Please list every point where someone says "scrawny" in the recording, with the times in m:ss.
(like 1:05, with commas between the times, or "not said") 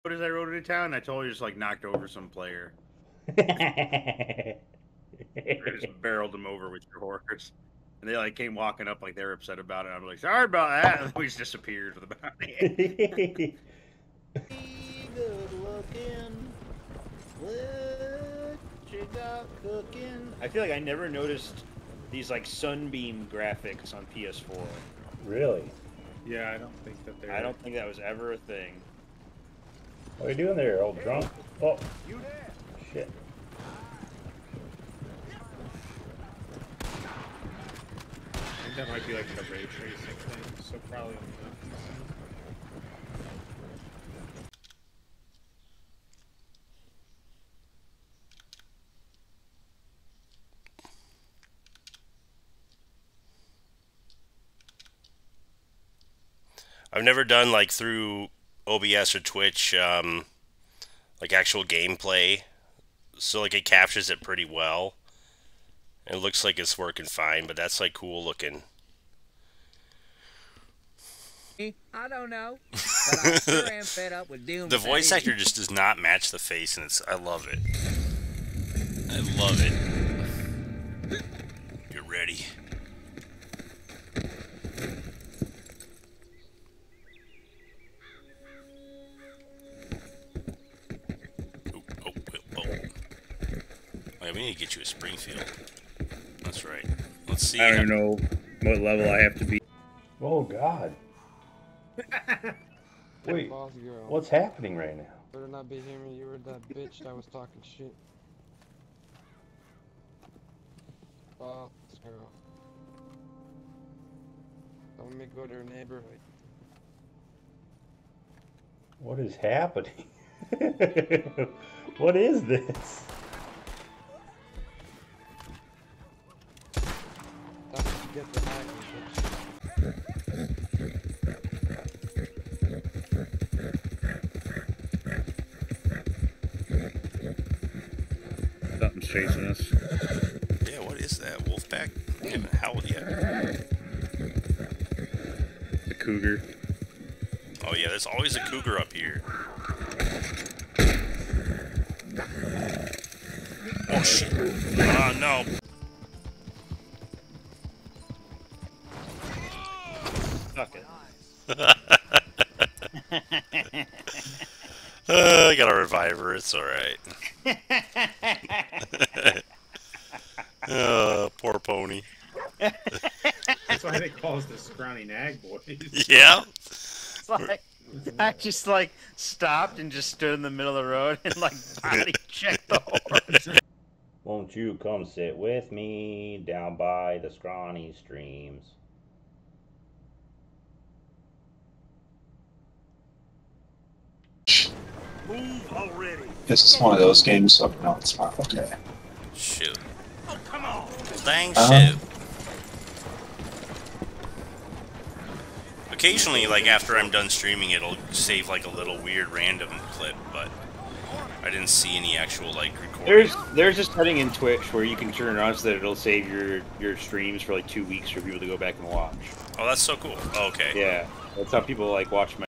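2:54, 3:07.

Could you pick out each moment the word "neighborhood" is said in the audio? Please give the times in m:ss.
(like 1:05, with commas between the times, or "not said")
1:55.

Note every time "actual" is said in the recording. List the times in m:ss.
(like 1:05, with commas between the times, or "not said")
1:01, 3:32.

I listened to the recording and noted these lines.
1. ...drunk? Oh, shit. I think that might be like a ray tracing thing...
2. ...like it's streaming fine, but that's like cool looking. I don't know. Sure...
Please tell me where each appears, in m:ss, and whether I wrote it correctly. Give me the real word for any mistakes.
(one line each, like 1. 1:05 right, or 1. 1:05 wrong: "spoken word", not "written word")
1. 0:31 right
2. 1:06 wrong: "working", not "streaming".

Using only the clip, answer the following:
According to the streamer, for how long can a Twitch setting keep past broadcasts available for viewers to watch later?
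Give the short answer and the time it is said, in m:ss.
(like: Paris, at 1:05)
2 weeks, at 3:37.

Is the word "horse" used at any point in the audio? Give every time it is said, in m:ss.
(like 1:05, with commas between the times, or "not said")
0:06, 3:02.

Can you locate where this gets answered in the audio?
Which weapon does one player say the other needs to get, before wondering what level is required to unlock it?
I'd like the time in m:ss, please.
1:34.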